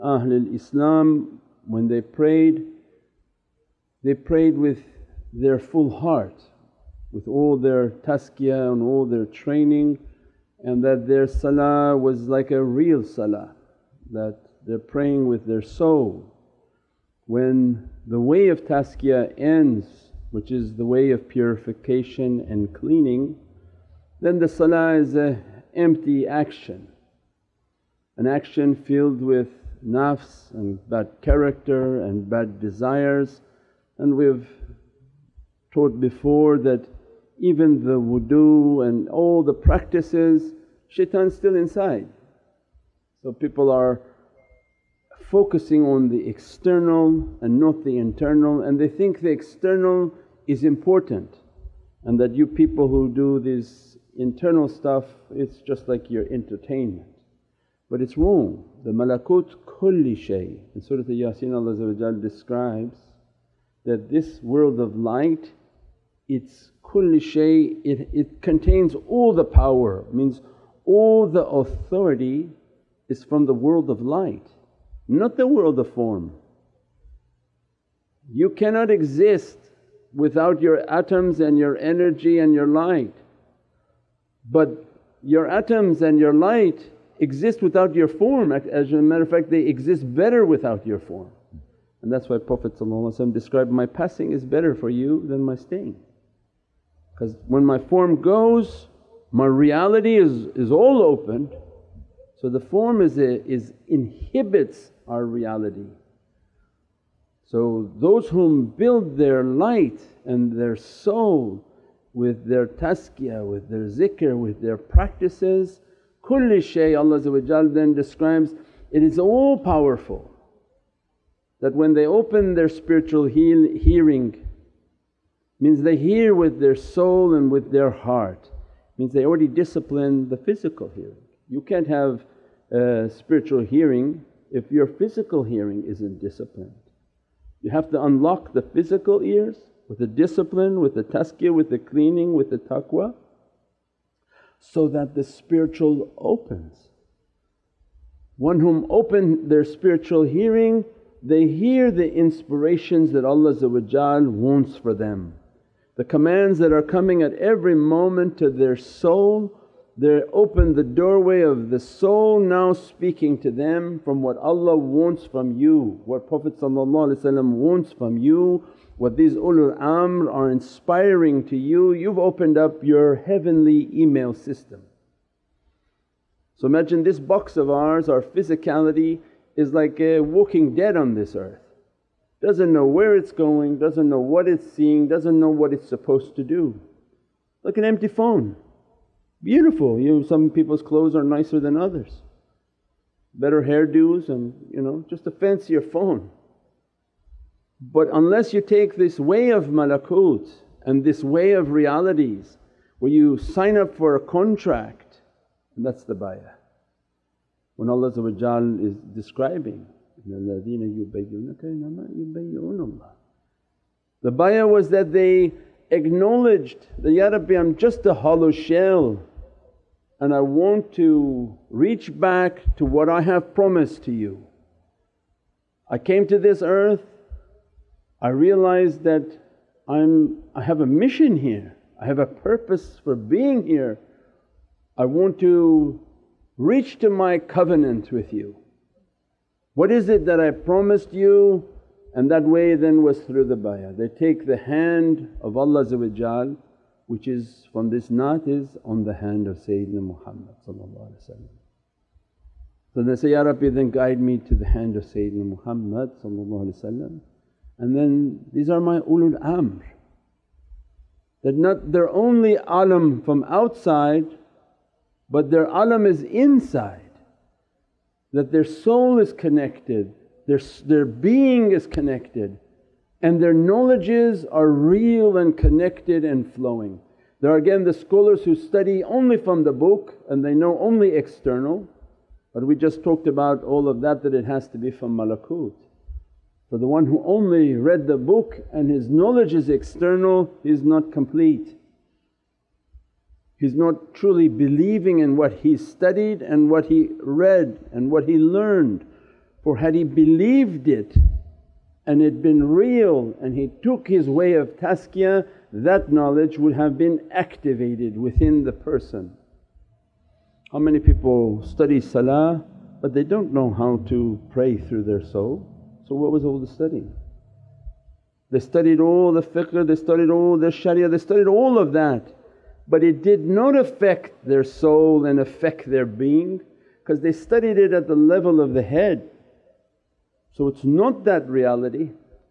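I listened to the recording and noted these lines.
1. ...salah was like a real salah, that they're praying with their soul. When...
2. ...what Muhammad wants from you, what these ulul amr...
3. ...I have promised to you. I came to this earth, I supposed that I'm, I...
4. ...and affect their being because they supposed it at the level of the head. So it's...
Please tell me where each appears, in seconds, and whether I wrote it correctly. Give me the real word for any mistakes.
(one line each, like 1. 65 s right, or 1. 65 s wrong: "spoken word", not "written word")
1. 11 s right
2. 166 s wrong: "Prophet", not "Muhammad"
3. 223 s wrong: "realized", not "supposed"
4. 325 s wrong: "studied", not "supposed".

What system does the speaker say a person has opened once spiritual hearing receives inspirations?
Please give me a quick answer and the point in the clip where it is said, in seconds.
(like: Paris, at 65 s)
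heavenly email system, at 173 s.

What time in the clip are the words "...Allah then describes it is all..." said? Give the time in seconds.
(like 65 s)
116 s.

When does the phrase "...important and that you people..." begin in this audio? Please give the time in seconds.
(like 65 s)
50 s.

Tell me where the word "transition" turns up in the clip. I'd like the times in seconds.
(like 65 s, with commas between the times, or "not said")
not said.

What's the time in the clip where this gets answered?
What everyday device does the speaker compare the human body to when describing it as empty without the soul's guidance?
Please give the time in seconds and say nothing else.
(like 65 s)
187 s.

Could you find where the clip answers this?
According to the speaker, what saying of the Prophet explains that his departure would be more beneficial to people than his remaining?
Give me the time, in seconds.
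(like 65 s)
93 s.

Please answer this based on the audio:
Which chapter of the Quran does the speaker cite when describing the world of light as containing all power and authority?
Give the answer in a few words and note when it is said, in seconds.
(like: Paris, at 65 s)
Surat Yasin, at 60 s.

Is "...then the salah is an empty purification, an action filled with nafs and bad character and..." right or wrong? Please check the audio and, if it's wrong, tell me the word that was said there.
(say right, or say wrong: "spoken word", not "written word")
wrong: "action", not "purification".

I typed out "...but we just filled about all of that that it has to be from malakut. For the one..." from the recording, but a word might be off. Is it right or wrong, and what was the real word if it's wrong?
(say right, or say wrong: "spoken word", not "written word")
wrong: "talked", not "filled".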